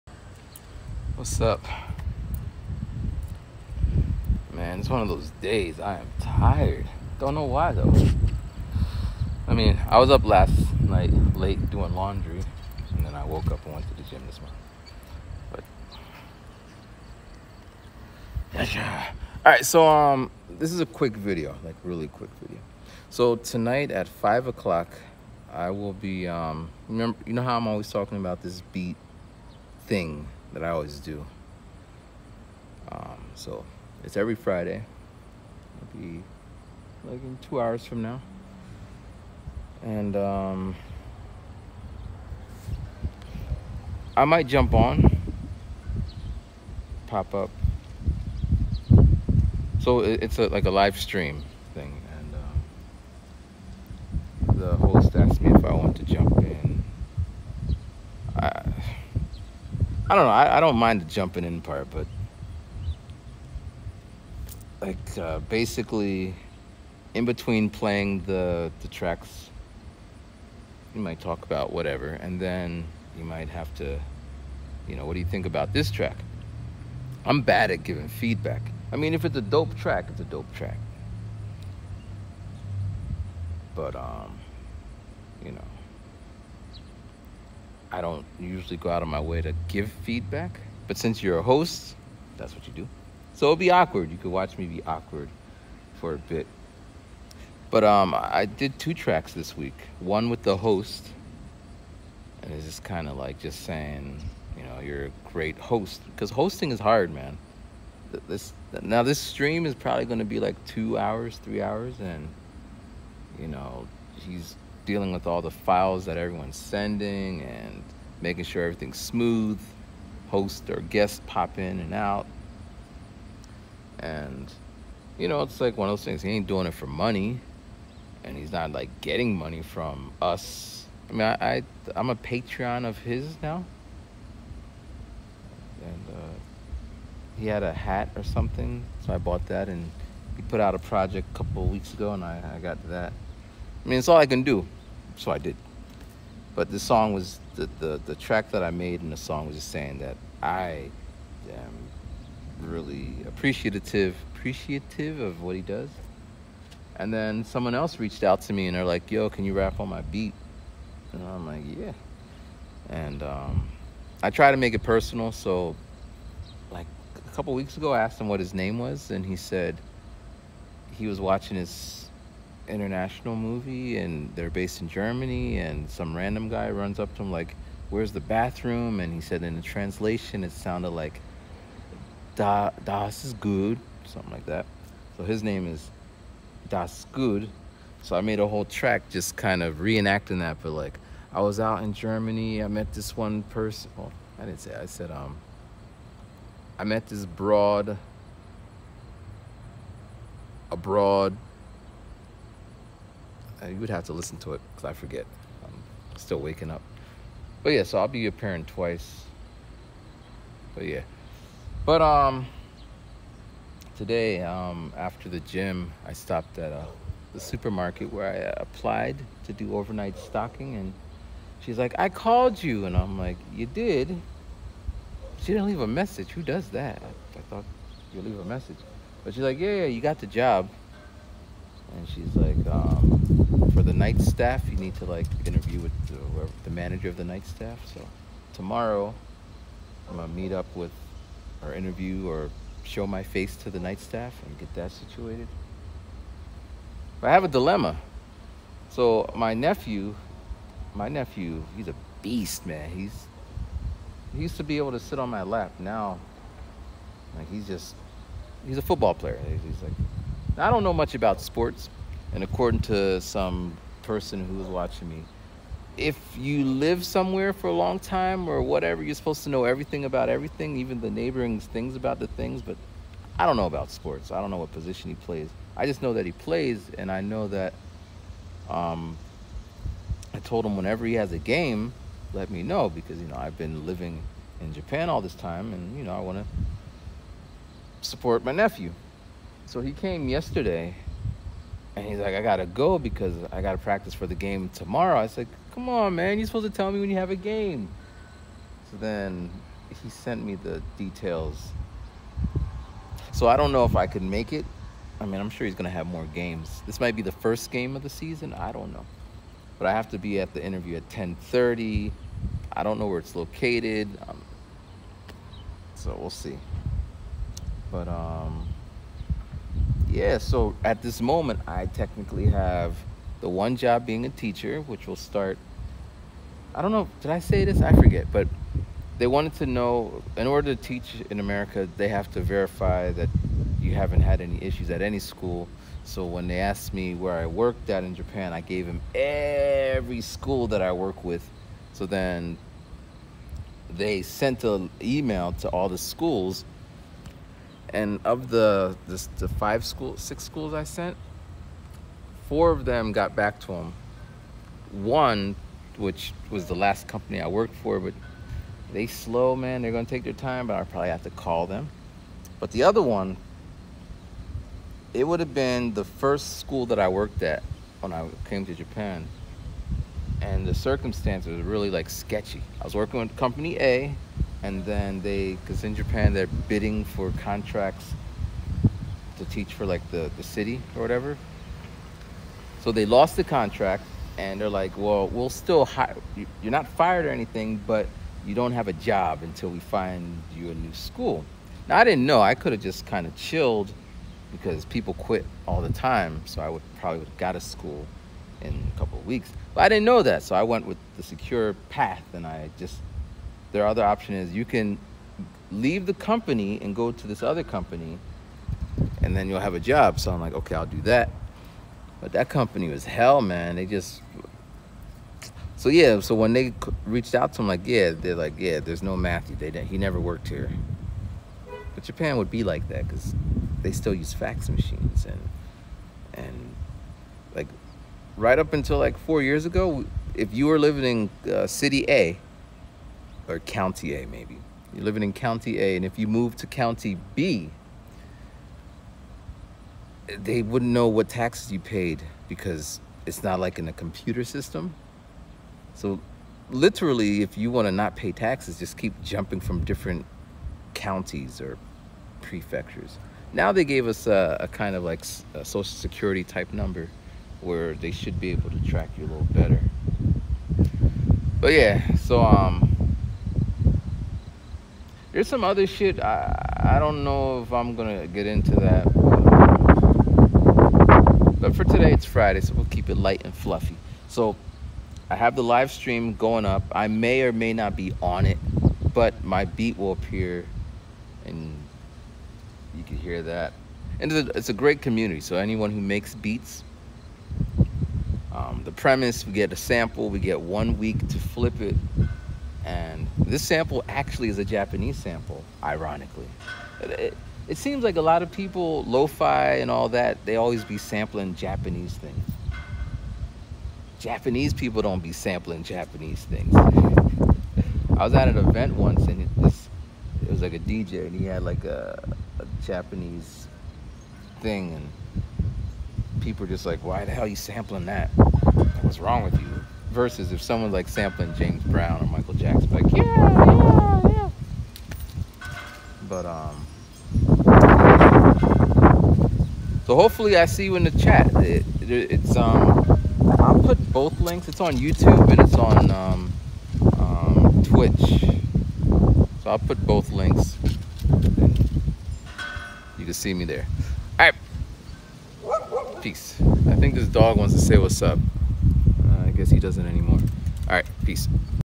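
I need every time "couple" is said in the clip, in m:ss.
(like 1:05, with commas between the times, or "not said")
2:21, 2:47, 6:38.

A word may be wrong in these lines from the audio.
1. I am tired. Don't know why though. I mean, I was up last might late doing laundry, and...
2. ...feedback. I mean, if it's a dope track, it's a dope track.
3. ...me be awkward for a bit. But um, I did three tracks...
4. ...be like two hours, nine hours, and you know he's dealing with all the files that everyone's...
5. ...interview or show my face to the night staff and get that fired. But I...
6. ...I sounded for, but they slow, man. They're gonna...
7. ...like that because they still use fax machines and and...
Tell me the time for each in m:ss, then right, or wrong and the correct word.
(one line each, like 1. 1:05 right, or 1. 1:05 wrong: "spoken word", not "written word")
1. 0:05 wrong: "night", not "might"
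2. 1:18 right
3. 1:34 wrong: "two", not "three"
4. 1:50 wrong: "three", not "nine"
5. 4:01 wrong: "situated", not "fired"
6. 5:57 wrong: "worked", not "sounded"
7. 7:02 right.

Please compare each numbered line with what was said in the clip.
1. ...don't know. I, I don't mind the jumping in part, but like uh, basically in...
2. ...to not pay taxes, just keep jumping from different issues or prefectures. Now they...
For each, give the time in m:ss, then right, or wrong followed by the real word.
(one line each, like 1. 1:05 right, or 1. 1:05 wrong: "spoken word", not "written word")
1. 1:00 right
2. 7:27 wrong: "counties", not "issues".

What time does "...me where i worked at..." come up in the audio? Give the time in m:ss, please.
5:36.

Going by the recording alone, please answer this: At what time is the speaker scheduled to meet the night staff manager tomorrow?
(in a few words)
10:30.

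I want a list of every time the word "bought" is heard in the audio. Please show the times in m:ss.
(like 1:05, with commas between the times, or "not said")
2:19.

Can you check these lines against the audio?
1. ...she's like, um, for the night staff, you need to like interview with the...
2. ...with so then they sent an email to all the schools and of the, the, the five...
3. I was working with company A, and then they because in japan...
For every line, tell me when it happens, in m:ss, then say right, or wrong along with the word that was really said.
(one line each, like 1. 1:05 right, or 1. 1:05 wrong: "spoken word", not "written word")
1. 3:52 right
2. 5:41 right
3. 6:12 right.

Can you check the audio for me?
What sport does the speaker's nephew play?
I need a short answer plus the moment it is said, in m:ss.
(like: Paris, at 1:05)
Football, at 4:18.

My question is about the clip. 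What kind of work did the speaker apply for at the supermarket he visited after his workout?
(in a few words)
Overnight stocking.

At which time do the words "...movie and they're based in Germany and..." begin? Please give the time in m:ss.
2:53.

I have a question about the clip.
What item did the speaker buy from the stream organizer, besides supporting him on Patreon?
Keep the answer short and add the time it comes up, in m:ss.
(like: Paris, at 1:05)
A hat, at 2:17.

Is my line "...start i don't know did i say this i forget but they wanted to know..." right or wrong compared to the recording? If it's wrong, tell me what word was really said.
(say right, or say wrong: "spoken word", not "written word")
right.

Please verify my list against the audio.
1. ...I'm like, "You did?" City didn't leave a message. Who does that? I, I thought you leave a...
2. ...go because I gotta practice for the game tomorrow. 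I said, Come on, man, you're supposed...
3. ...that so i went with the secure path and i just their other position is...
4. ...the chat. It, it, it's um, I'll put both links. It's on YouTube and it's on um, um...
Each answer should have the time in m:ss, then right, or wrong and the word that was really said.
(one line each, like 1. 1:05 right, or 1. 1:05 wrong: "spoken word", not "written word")
1. 3:42 wrong: "She", not "City"
2. 4:52 right
3. 6:40 wrong: "option", not "position"
4. 8:51 right.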